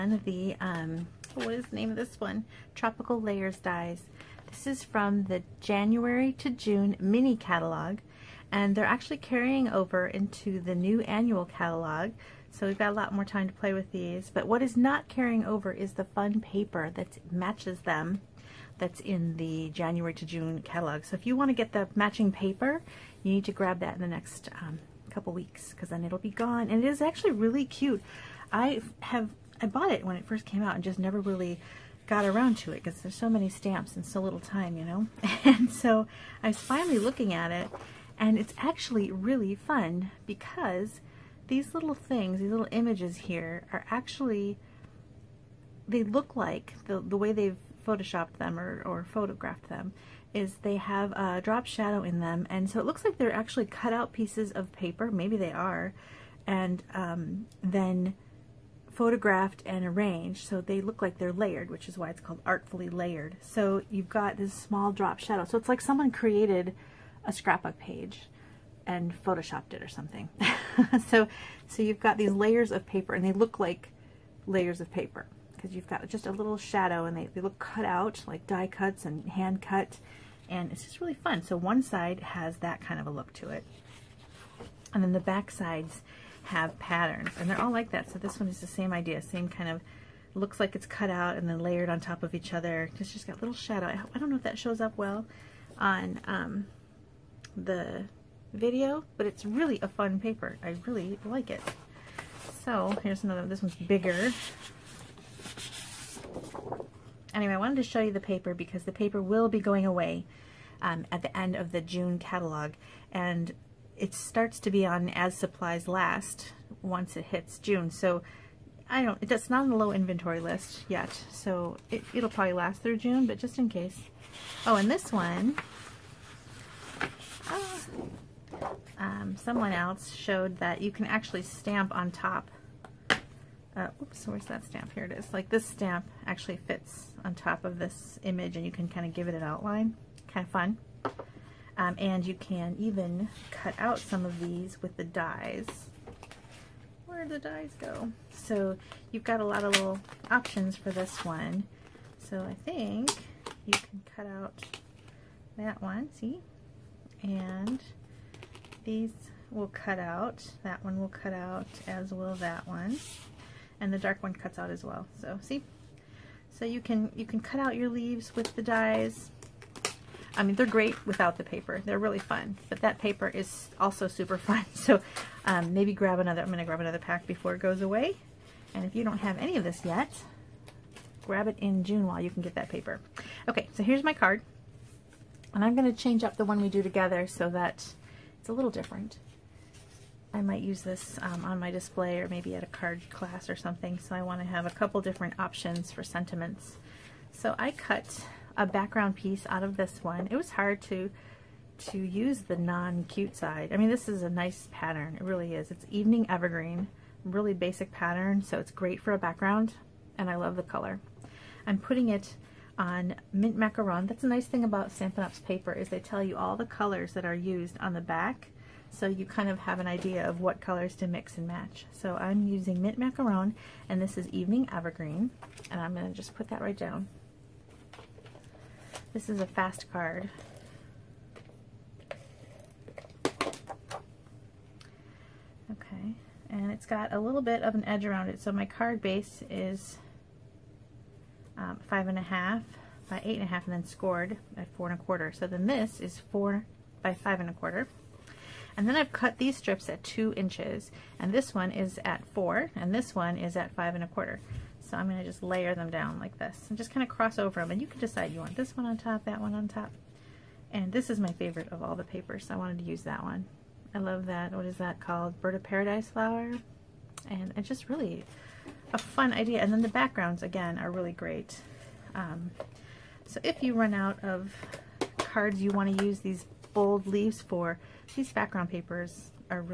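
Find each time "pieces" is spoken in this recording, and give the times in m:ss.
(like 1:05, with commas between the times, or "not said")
0:54, 3:19.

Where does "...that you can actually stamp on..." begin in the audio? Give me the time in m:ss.
2:10.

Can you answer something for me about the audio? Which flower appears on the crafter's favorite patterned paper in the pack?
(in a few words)
Bird of Paradise.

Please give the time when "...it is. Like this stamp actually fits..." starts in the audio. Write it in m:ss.
2:15.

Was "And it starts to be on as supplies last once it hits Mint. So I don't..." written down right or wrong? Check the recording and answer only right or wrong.
wrong.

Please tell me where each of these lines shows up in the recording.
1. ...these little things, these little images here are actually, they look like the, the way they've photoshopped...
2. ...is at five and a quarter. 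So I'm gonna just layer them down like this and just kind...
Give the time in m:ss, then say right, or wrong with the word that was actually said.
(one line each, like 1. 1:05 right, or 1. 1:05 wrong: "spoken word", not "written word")
1. 0:41 right
2. 4:13 right.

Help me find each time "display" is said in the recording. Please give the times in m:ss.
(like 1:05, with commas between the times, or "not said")
3:11.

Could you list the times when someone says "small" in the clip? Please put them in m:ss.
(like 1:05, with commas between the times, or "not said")
1:04.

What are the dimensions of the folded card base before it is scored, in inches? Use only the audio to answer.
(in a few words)
5 1/2 by 8 1/2.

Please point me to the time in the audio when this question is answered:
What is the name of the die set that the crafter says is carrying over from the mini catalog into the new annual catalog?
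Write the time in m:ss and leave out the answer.
0:02.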